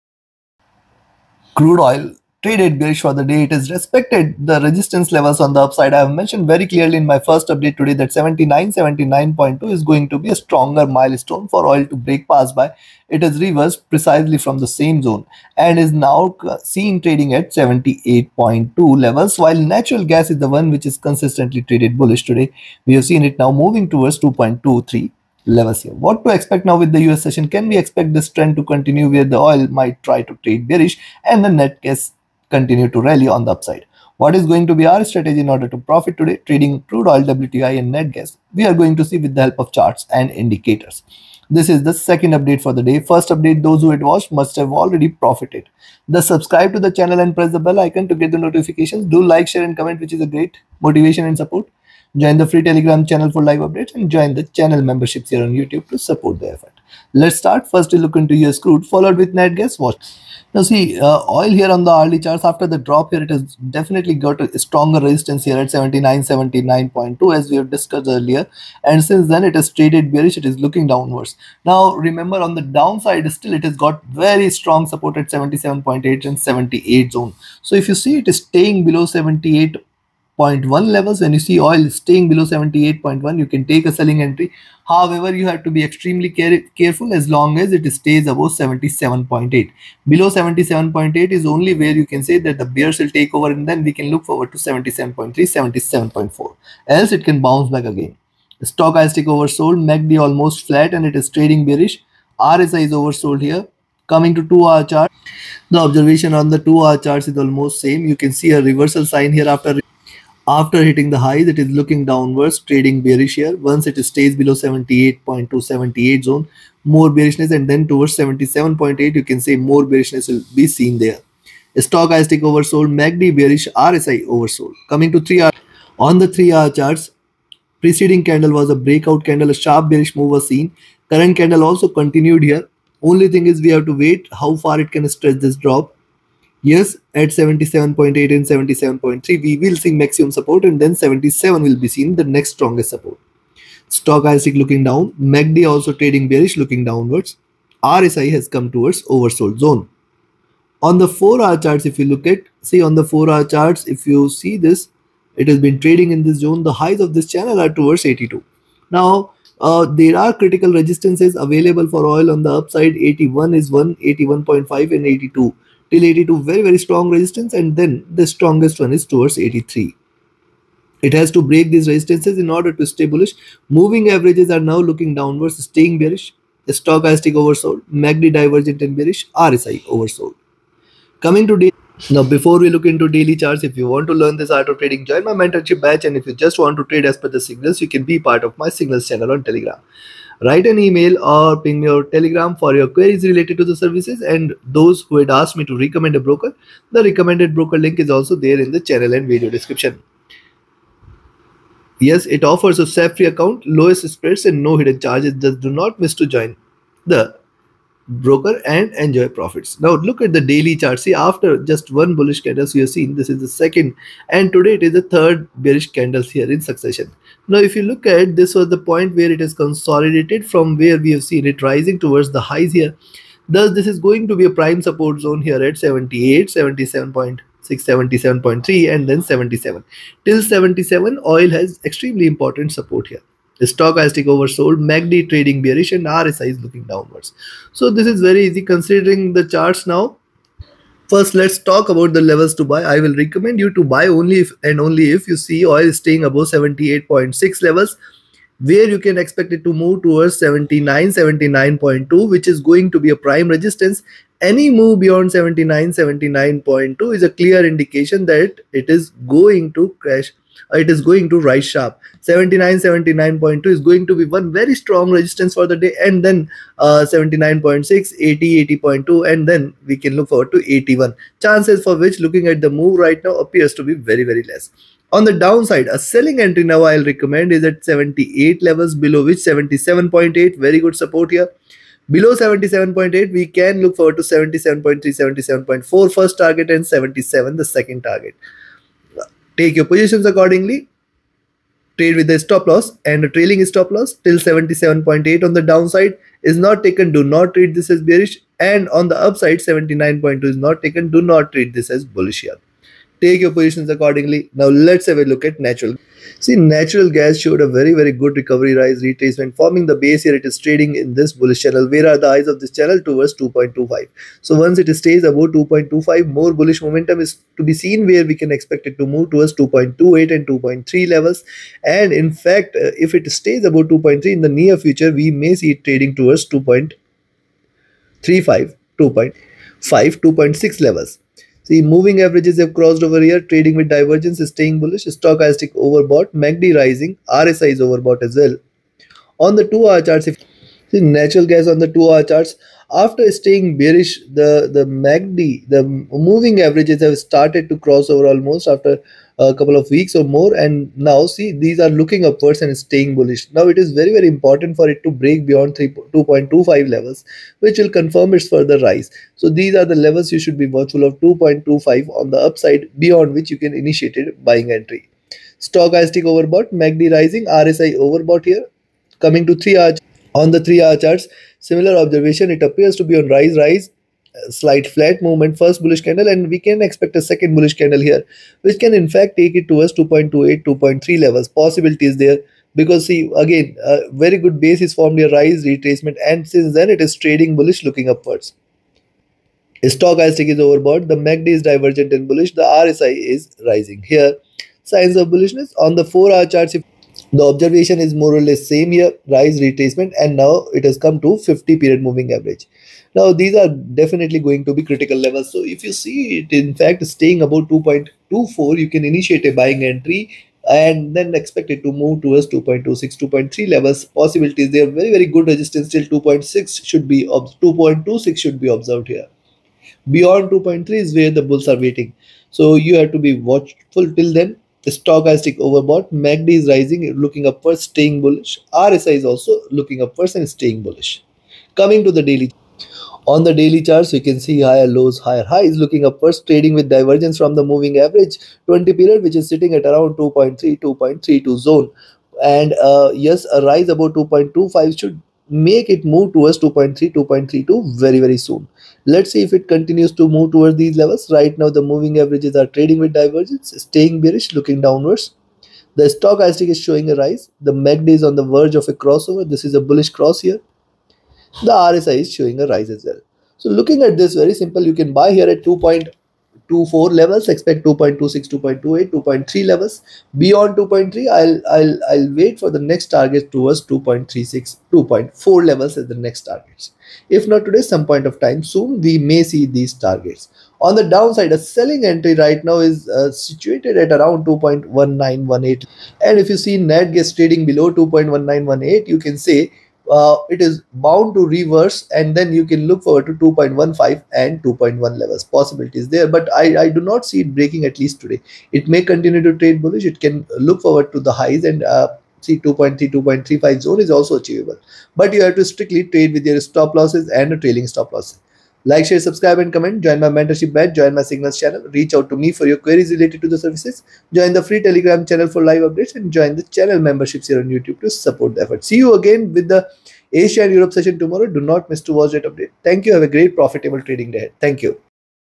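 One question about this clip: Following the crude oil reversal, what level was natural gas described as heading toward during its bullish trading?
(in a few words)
2.23.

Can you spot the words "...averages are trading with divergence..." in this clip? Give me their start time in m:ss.
7:32.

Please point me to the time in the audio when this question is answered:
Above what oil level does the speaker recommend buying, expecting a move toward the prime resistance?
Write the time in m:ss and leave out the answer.
4:06.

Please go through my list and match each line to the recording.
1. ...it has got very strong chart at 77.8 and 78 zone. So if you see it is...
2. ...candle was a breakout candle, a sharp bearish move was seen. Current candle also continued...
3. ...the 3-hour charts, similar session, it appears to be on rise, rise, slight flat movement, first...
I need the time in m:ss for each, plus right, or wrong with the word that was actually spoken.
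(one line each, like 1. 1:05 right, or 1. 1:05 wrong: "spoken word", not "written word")
1. 1:13 wrong: "support", not "chart"
2. 2:08 right
3. 6:10 wrong: "observation", not "session".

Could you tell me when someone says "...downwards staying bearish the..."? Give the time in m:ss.
2:55.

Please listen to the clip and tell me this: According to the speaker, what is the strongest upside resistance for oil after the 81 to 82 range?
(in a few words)
83.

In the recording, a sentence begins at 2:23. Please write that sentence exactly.
Stock is looking down, MACD also trading bearish looking downwards.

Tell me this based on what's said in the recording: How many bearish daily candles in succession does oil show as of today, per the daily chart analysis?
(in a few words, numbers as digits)
3.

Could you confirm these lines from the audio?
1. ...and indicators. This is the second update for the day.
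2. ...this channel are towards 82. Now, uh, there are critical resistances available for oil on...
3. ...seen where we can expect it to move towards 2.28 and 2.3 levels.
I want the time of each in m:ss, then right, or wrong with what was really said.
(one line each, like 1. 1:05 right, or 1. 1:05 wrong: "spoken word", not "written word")
1. 0:40 right
2. 2:37 right
3. 5:17 right.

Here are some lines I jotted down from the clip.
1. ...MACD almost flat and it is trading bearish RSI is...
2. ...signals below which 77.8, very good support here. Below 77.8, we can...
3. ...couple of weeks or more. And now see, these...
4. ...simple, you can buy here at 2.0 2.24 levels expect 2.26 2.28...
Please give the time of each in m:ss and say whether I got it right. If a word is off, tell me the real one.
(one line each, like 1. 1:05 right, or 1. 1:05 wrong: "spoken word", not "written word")
1. 1:39 right
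2. 4:38 wrong: "levels", not "signals"
3. 5:49 right
4. 7:44 right.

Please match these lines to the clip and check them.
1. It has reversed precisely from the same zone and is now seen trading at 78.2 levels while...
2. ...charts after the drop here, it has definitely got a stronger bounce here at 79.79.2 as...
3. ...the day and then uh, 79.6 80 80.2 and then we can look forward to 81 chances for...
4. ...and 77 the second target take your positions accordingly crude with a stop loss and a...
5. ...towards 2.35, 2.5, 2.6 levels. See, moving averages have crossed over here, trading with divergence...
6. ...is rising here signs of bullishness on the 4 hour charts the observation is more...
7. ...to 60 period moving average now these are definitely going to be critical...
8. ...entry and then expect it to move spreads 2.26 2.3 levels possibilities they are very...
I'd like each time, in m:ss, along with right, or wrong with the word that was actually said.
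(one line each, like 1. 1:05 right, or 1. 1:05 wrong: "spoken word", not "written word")
1. 0:13 right
2. 1:02 wrong: "resistance", not "bounce"
3. 4:25 right
4. 4:46 wrong: "trade", not "crude"
5. 5:26 right
6. 6:33 right
7. 6:41 wrong: "50", not "60"
8. 6:49 wrong: "towards", not "spreads".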